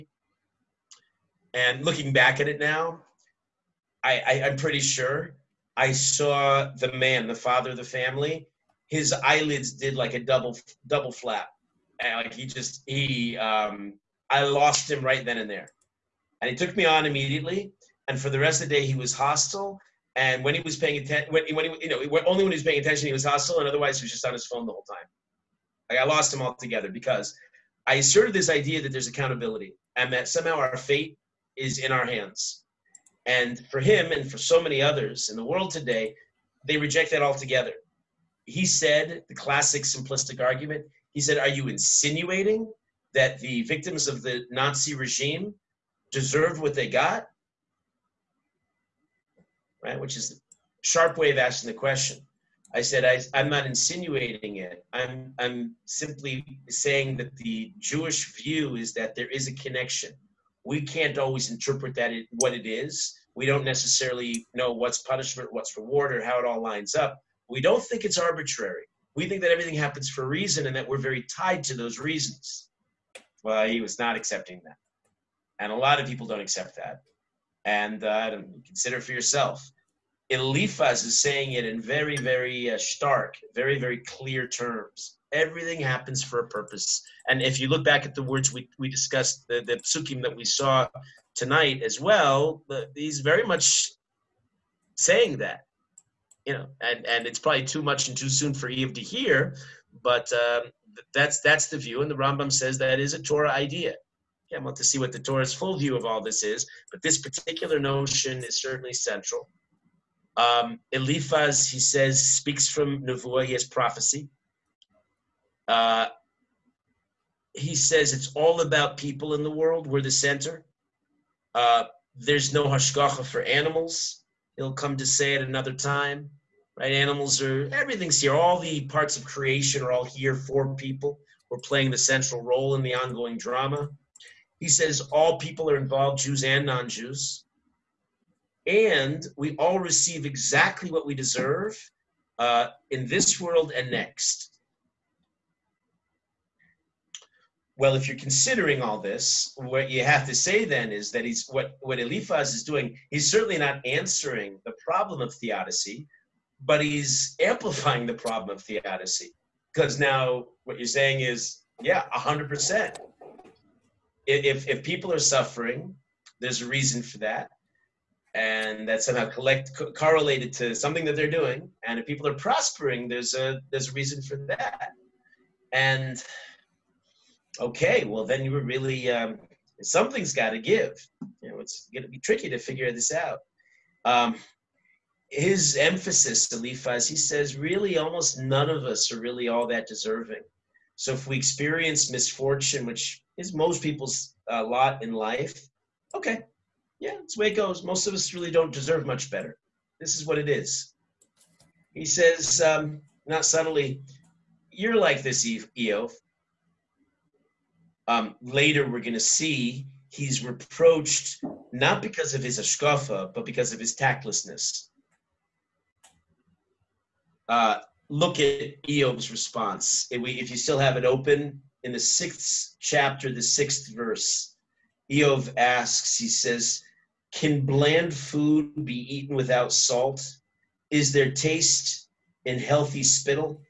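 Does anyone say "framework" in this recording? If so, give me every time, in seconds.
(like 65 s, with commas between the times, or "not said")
not said.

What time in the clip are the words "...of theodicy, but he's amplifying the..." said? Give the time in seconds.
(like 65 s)
155 s.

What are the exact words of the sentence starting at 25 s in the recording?
Like I lost him altogether because I asserted this idea that there's accountability and that somehow our fate is in our hands.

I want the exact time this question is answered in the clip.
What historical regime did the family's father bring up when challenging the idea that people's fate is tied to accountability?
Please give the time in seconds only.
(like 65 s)
44 s.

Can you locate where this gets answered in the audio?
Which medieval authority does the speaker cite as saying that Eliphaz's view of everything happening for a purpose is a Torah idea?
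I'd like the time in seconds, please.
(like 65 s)
102 s.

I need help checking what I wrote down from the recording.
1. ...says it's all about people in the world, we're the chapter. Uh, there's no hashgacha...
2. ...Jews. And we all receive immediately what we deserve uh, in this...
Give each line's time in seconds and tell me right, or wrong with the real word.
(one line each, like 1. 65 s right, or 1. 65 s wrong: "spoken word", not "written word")
1. 117 s wrong: "center", not "chapter"
2. 136 s wrong: "exactly", not "immediately".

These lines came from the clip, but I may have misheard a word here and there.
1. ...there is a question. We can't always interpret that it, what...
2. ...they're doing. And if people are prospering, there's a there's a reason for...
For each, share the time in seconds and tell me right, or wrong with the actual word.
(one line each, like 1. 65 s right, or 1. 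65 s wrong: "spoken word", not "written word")
1. 59 s wrong: "connection", not "question"
2. 171 s right.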